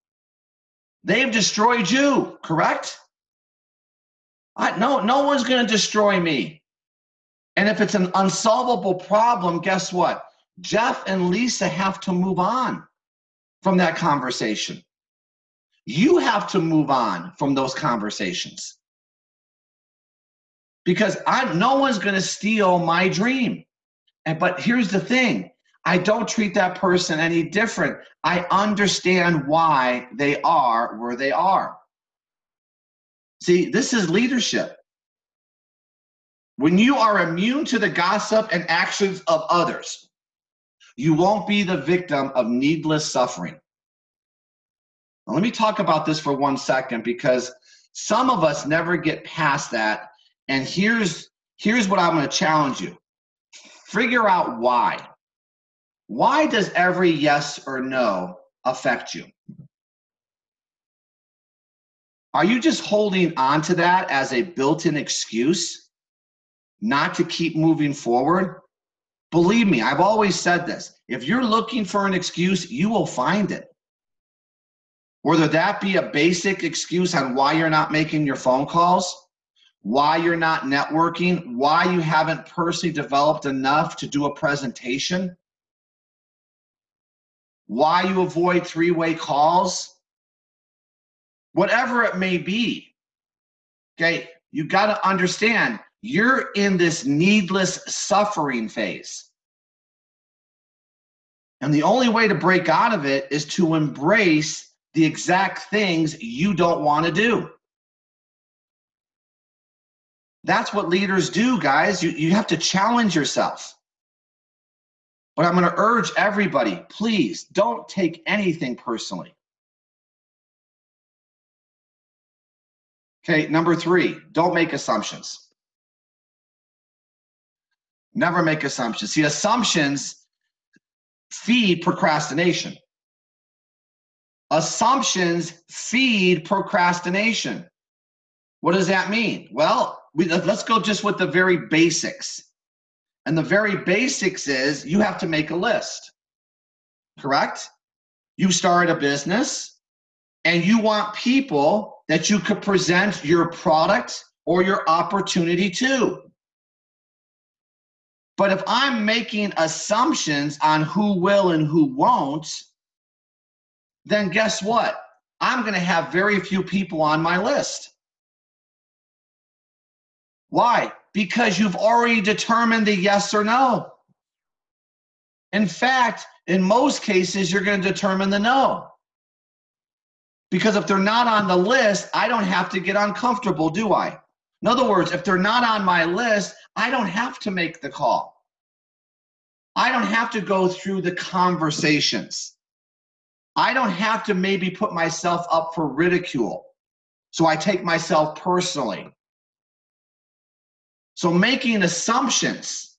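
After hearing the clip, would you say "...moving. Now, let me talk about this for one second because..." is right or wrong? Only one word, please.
wrong.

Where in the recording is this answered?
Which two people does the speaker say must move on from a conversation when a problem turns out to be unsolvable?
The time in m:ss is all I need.
0:10.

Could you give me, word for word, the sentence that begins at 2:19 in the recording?
Well, we, let's go just with the very basics.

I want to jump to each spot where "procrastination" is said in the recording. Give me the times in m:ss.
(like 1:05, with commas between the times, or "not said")
2:11, 2:16.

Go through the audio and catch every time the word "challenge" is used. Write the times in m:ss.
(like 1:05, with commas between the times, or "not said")
0:52, 1:52.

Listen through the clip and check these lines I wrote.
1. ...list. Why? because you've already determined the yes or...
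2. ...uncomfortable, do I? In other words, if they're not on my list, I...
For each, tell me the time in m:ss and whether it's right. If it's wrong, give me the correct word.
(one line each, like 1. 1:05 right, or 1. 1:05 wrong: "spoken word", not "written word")
1. 2:47 right
2. 3:02 right.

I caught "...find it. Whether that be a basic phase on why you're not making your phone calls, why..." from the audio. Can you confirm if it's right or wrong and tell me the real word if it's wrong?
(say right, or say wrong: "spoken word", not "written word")
wrong: "excuse", not "phase".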